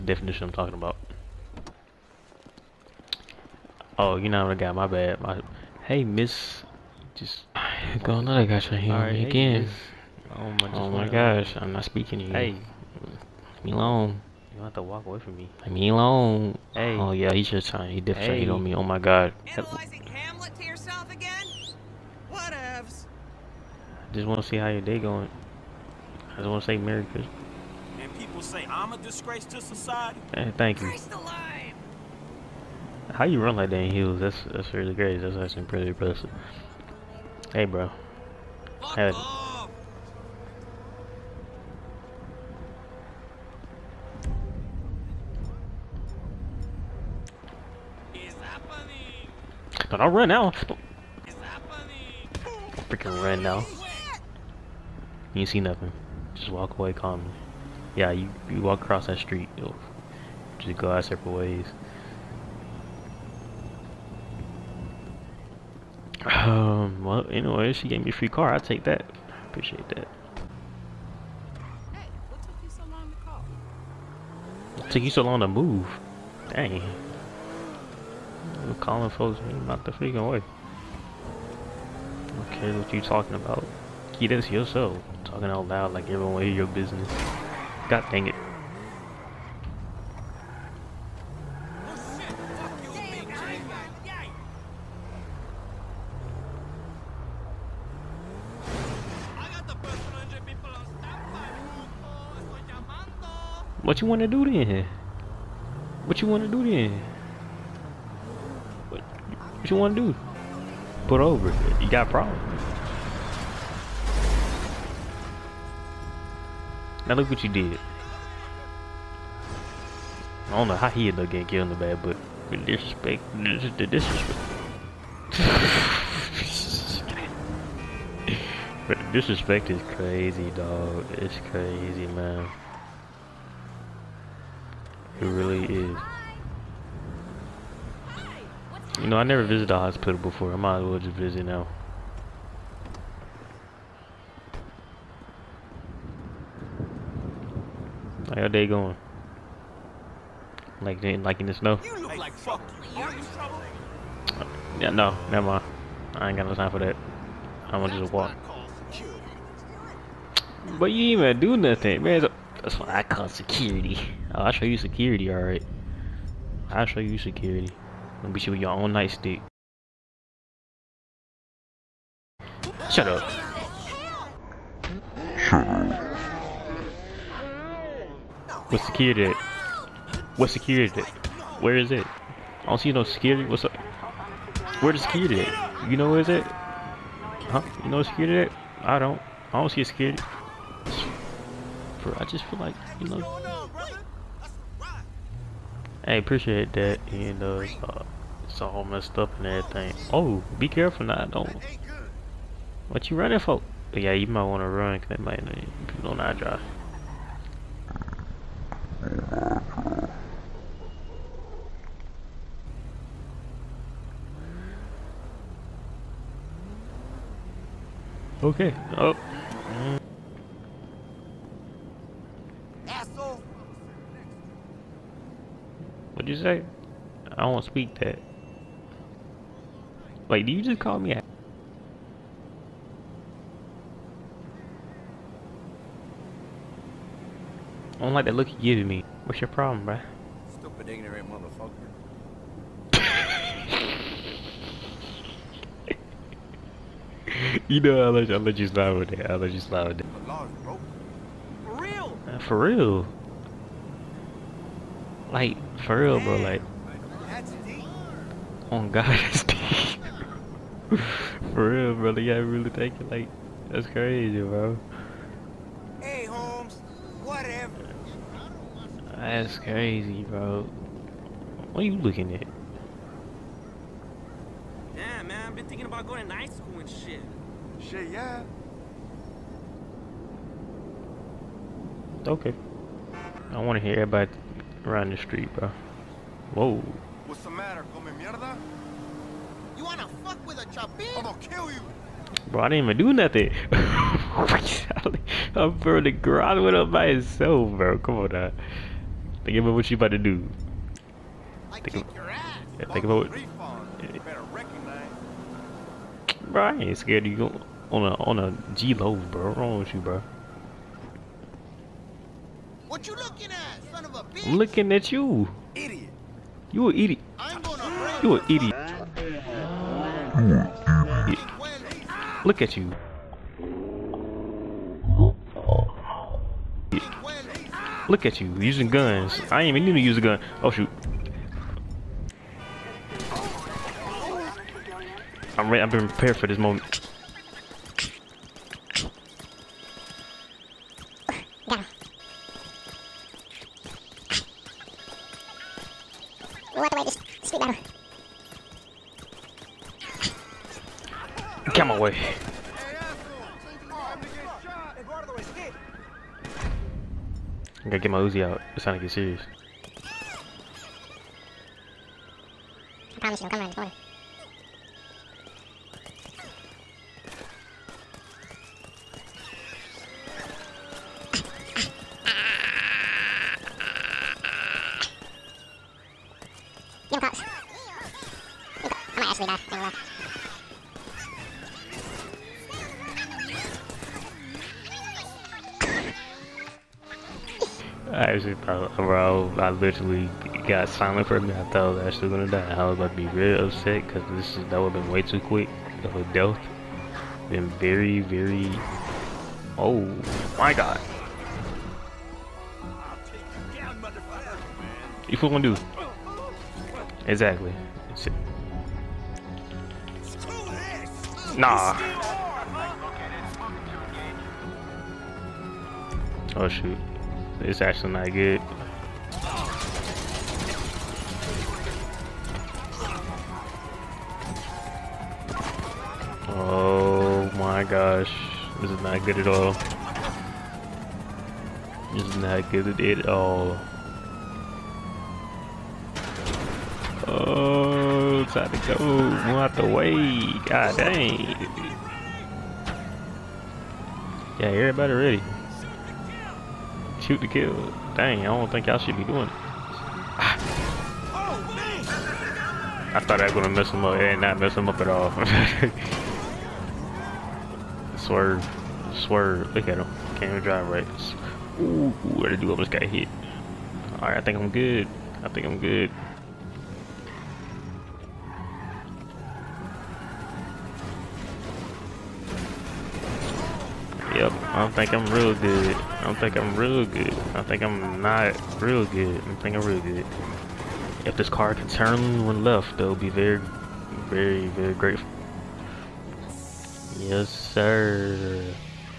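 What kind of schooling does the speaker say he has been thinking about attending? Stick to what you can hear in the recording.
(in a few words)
night school.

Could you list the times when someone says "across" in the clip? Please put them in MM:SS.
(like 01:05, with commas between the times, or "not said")
00:58.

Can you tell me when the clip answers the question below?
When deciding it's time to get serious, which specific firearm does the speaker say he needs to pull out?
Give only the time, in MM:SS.
05:58.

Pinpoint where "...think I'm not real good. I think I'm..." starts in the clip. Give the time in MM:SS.
07:57.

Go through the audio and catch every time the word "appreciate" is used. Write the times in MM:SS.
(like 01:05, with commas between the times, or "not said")
01:09, 03:16.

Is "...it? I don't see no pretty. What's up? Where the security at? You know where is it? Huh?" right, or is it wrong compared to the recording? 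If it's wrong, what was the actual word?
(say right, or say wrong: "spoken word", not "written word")
wrong: "security", not "pretty".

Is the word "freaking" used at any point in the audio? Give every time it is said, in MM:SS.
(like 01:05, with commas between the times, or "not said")
00:52, 01:19.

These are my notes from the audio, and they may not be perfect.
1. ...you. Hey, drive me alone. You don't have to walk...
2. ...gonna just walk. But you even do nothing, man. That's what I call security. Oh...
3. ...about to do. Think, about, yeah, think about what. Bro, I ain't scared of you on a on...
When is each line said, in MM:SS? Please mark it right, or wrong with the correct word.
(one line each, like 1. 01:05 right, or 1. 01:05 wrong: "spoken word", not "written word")
1. 00:12 wrong: "leave", not "drive"
2. 02:37 right
3. 04:59 right.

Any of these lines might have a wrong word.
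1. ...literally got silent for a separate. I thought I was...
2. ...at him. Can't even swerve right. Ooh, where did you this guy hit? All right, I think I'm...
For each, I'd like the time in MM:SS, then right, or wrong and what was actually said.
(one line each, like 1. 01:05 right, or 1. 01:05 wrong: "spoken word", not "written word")
1. 06:29 wrong: "minute", not "separate"
2. 07:39 wrong: "drive", not "swerve".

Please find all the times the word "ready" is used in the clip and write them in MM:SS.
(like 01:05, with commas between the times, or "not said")
05:35, 07:25.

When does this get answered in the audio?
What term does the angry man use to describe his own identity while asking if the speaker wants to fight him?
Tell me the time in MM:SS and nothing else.
04:50.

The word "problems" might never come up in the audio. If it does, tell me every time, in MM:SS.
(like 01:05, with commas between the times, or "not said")
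01:52, 03:59.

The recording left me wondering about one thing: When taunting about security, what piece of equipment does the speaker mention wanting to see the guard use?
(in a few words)
nightstick.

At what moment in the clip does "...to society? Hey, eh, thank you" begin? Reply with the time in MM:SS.
00:29.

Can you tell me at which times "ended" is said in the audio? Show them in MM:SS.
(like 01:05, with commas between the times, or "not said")
02:01.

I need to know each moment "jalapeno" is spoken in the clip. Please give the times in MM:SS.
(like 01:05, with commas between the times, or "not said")
not said.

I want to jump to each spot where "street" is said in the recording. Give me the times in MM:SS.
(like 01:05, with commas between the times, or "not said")
00:59, 04:45.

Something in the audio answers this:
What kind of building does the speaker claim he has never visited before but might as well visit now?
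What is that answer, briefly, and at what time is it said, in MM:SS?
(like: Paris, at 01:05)
a hospital, at 02:19.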